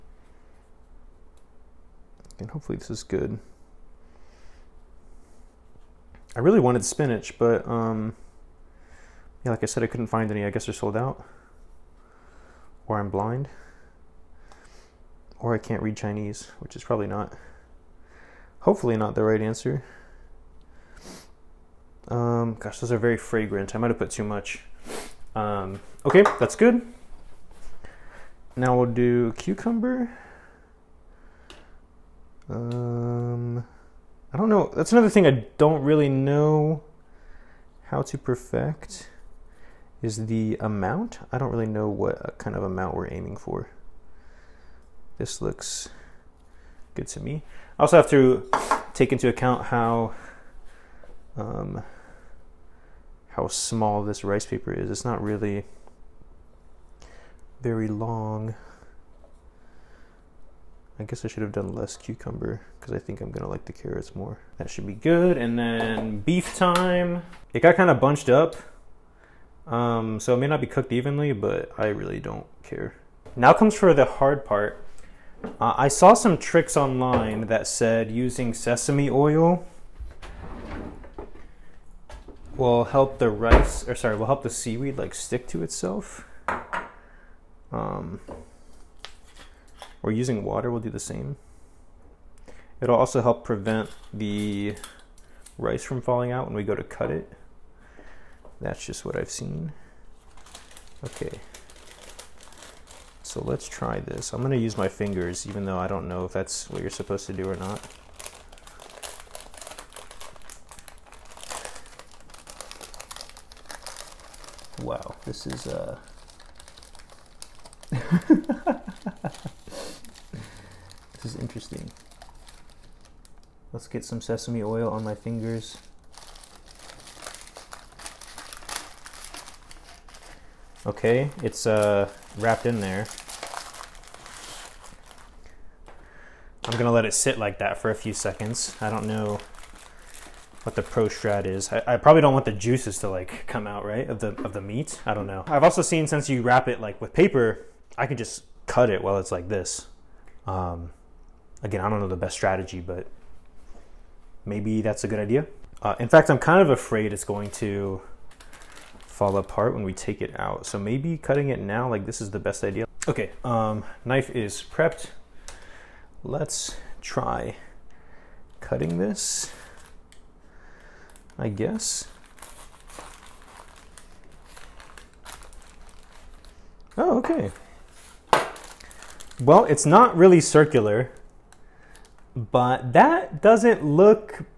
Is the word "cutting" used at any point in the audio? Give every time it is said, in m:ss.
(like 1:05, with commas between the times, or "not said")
2:41, 2:48.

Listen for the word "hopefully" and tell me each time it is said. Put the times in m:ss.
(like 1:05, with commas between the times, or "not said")
0:02, 0:18.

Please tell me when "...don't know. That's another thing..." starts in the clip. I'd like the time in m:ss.
0:34.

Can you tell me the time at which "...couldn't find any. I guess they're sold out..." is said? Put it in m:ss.
0:09.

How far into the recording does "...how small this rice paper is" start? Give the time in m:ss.
0:53.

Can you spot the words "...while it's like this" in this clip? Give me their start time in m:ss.
2:29.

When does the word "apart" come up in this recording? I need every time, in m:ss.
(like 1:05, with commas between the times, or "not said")
2:39.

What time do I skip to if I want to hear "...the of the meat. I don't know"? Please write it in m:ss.
2:24.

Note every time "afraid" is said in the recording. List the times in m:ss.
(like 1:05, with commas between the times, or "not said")
2:36.